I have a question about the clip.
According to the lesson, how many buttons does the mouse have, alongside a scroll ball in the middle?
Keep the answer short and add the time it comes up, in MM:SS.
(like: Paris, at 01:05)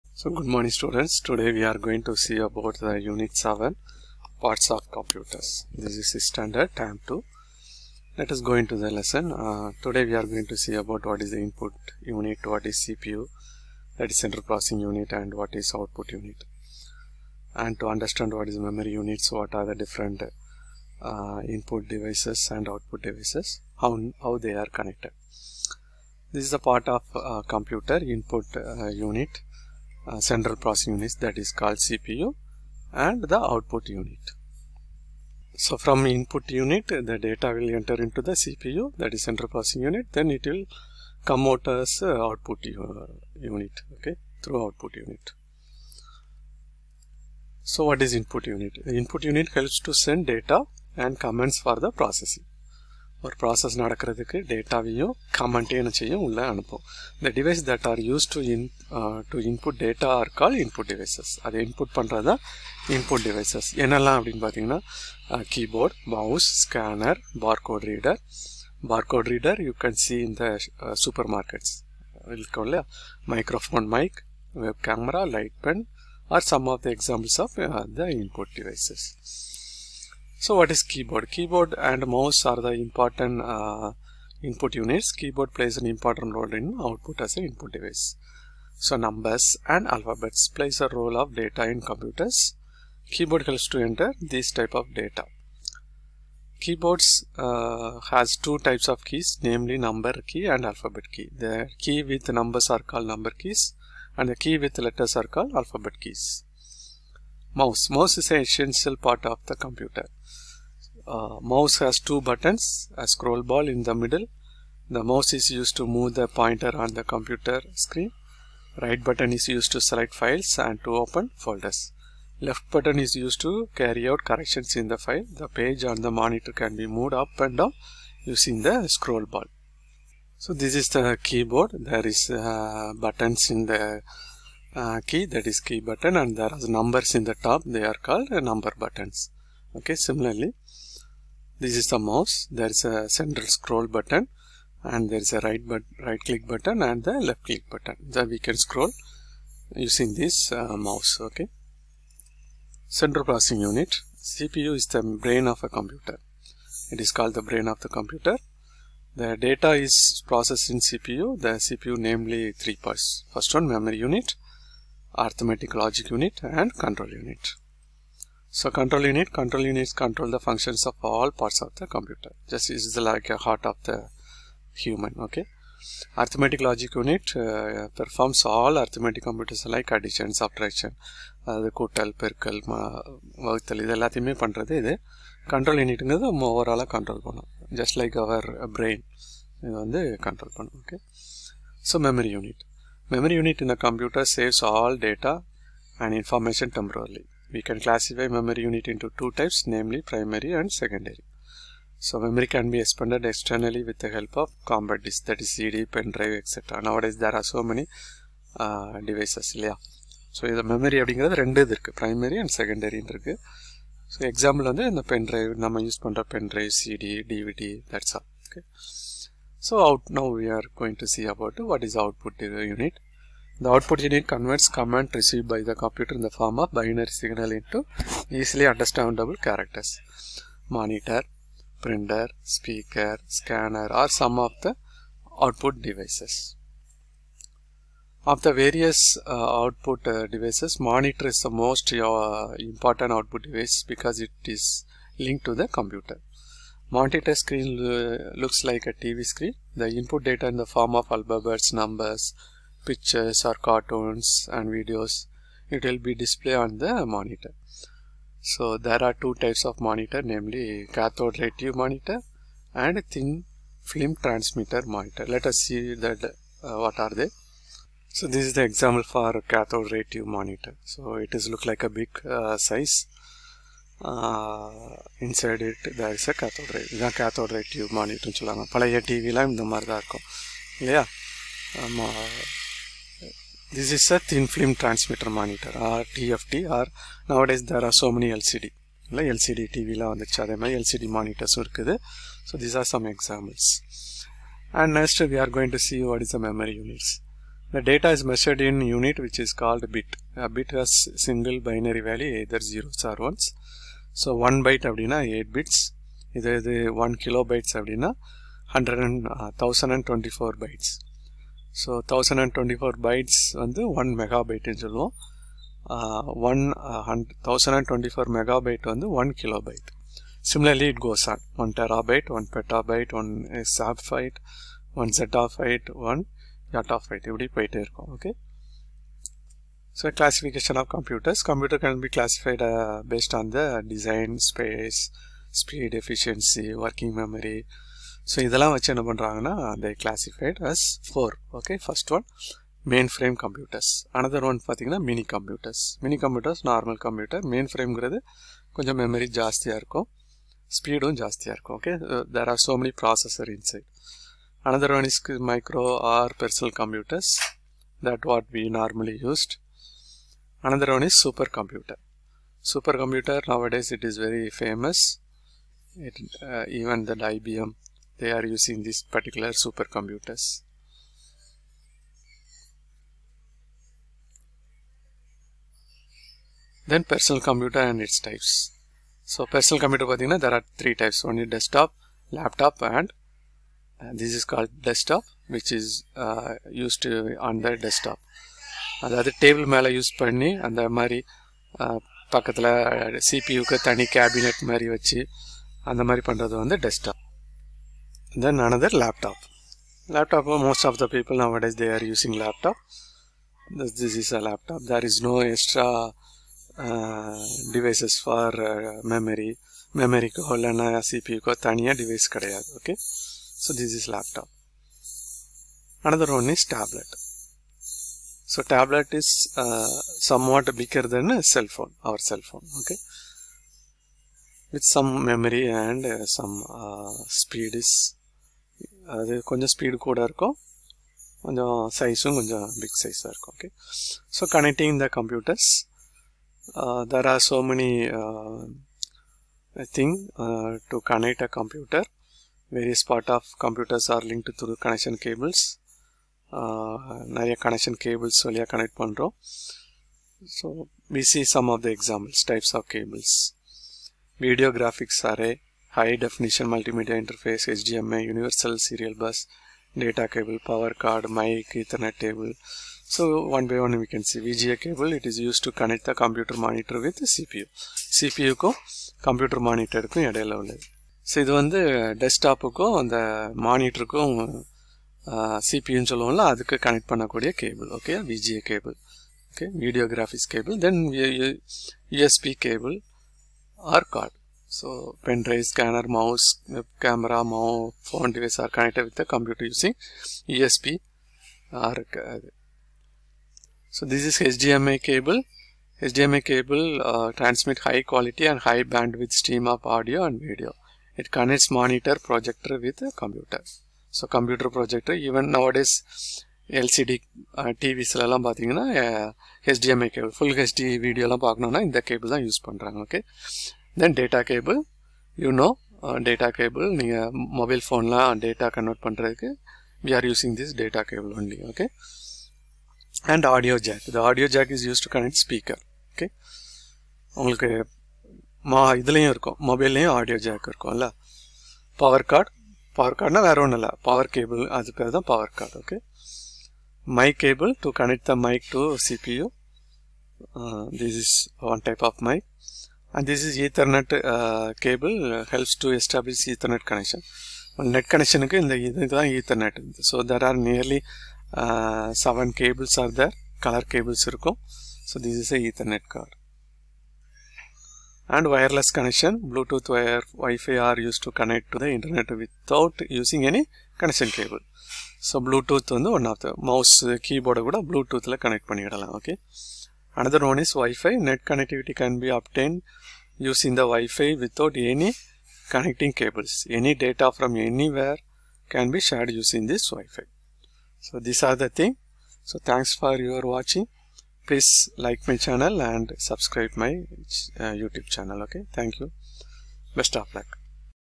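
2, at 01:51.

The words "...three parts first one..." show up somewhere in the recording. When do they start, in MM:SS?
02:42.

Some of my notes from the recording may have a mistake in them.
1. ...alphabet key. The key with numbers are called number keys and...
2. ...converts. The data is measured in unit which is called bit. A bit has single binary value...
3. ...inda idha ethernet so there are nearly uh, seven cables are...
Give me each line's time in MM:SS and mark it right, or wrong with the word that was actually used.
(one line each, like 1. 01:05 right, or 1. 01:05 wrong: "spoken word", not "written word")
1. 01:40 right
2. 04:56 wrong: "units", not "converts"
3. 09:08 right.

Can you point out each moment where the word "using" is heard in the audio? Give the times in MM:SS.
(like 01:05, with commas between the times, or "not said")
02:08, 02:29, 06:08, 06:42, 08:09, 09:23, 09:33, 09:39.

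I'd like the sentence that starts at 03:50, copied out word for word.
Monitor, printer, speaker, scanner are some of the output devices.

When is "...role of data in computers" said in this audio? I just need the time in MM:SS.
01:30.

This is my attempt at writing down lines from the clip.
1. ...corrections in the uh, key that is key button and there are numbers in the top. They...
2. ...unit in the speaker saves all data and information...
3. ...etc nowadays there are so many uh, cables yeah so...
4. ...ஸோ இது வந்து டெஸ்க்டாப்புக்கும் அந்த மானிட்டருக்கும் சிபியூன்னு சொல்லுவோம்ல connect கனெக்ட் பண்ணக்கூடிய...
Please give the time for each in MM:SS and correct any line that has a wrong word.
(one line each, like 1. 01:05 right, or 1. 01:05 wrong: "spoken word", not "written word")
1. 02:12 wrong: "buttons", not "corrections"
2. 03:13 wrong: "computer", not "speaker"
3. 03:26 wrong: "devices", not "cables"
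4. 07:51 right.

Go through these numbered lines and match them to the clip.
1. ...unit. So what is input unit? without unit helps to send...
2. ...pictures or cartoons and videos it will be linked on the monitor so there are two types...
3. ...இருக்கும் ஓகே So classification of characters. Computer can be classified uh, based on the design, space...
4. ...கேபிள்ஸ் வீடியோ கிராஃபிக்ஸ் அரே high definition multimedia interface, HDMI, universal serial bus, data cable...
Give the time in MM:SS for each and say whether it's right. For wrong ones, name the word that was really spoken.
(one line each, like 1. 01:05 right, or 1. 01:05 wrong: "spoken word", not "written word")
1. 00:44 wrong: "input", not "without"
2. 04:12 wrong: "displayed", not "linked"
3. 05:27 wrong: "computers", not "characters"
4. 07:32 right.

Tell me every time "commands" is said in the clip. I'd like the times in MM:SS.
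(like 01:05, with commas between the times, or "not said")
00:51, 03:44.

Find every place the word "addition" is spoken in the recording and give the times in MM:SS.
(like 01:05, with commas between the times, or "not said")
02:59.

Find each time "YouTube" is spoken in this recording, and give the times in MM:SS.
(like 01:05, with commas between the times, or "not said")
09:47.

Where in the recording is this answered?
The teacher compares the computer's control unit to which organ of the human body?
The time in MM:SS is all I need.
02:53.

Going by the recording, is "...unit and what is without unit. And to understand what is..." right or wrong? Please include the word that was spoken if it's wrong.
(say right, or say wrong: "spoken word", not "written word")
wrong: "output", not "without".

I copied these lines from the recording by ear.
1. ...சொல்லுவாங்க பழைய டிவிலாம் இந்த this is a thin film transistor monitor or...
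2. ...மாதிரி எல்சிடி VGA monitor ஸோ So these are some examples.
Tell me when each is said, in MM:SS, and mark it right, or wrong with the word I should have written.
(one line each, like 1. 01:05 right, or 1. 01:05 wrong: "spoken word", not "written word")
1. 04:38 right
2. 04:50 wrong: "LCD", not "VGA".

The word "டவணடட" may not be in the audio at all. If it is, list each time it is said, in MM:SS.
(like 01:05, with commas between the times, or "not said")
05:12, 05:17.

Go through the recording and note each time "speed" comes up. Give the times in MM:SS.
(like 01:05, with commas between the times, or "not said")
05:35, 07:07.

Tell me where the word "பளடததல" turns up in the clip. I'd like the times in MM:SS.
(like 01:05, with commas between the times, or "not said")
09:27.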